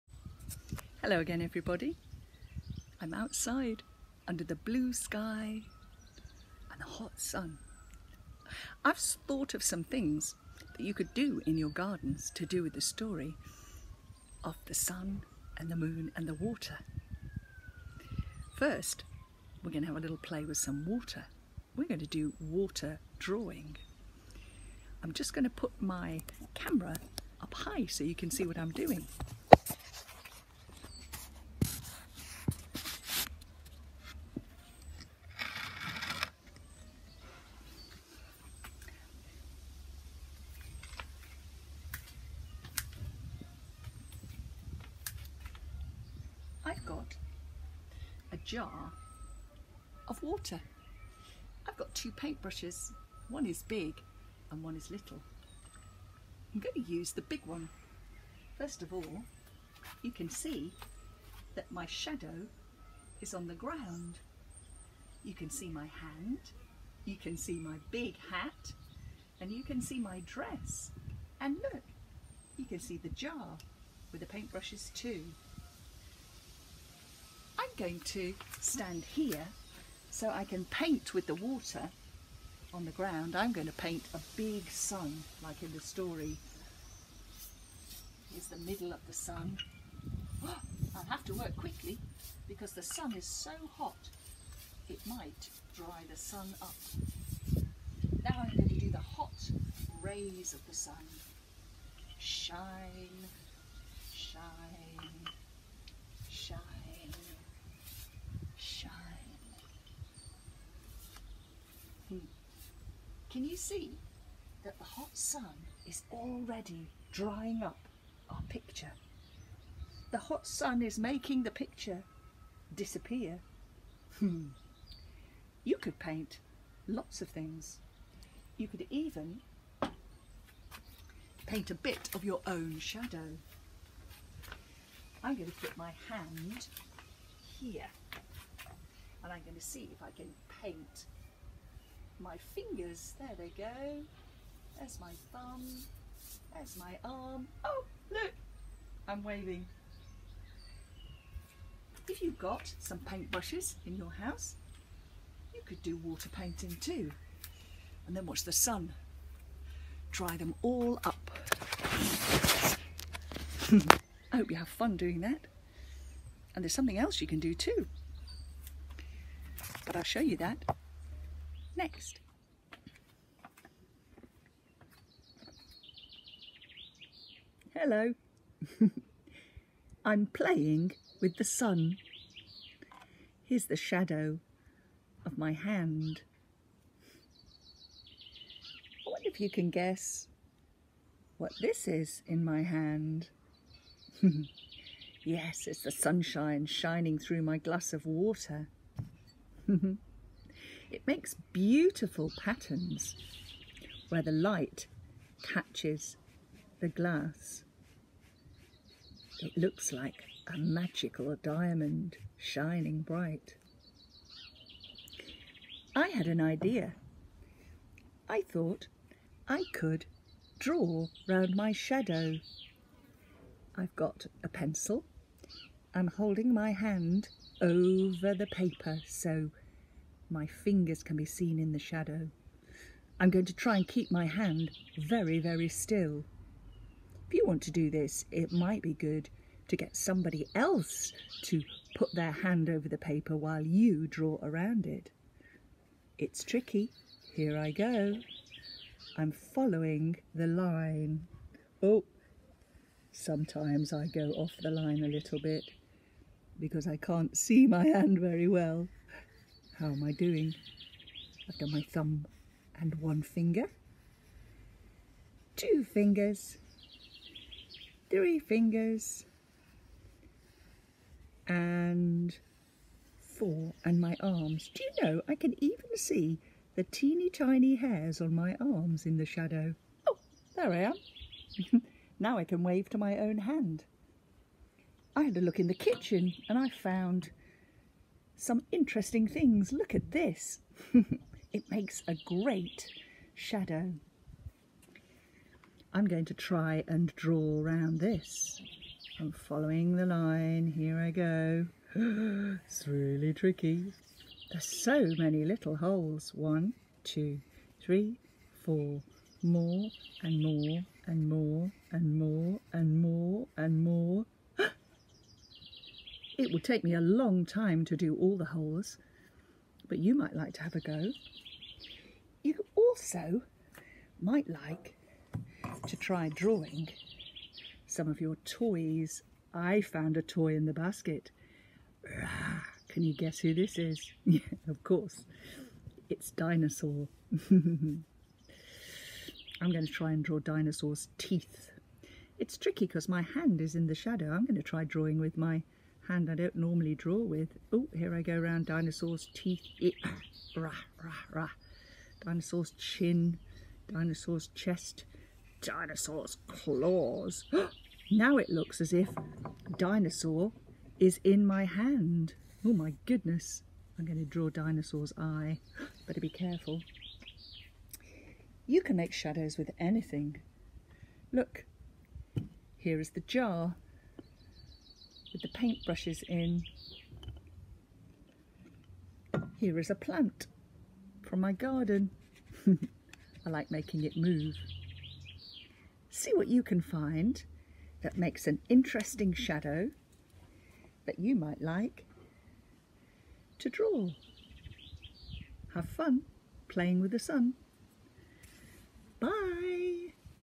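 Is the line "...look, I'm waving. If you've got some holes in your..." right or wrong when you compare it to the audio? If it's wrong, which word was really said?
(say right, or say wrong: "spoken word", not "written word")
wrong: "paintbrushes", not "holes".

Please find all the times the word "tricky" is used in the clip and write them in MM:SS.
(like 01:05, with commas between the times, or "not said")
04:06, 05:03, 05:42.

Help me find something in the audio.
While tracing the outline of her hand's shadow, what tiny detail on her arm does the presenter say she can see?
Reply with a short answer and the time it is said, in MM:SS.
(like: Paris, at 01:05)
teeny tiny hairs, at 04:36.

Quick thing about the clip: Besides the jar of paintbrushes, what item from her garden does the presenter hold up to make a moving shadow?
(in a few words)
a plant.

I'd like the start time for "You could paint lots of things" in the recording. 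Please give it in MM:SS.
02:05.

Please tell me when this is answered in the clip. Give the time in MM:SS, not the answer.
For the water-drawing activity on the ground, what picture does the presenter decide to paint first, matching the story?
01:24.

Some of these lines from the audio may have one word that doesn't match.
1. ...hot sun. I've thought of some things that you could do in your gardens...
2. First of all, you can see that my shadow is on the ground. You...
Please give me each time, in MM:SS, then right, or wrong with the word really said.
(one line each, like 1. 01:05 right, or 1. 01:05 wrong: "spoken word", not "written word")
1. 00:06 right
2. 00:58 right.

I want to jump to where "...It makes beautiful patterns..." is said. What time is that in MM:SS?
03:20.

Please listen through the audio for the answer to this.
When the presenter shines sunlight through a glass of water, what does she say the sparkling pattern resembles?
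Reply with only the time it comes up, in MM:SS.
03:30.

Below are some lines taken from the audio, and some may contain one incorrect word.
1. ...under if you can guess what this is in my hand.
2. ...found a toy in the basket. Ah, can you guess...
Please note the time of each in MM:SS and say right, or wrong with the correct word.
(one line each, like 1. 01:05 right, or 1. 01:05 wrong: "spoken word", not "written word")
1. 03:09 wrong: "wonder", not "under"
2. 05:29 right.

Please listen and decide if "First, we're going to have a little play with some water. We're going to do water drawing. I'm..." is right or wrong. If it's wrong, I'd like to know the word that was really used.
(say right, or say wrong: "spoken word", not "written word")
right.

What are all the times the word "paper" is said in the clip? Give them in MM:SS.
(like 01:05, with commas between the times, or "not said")
03:48, 04:02.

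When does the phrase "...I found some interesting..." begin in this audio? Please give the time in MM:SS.
04:46.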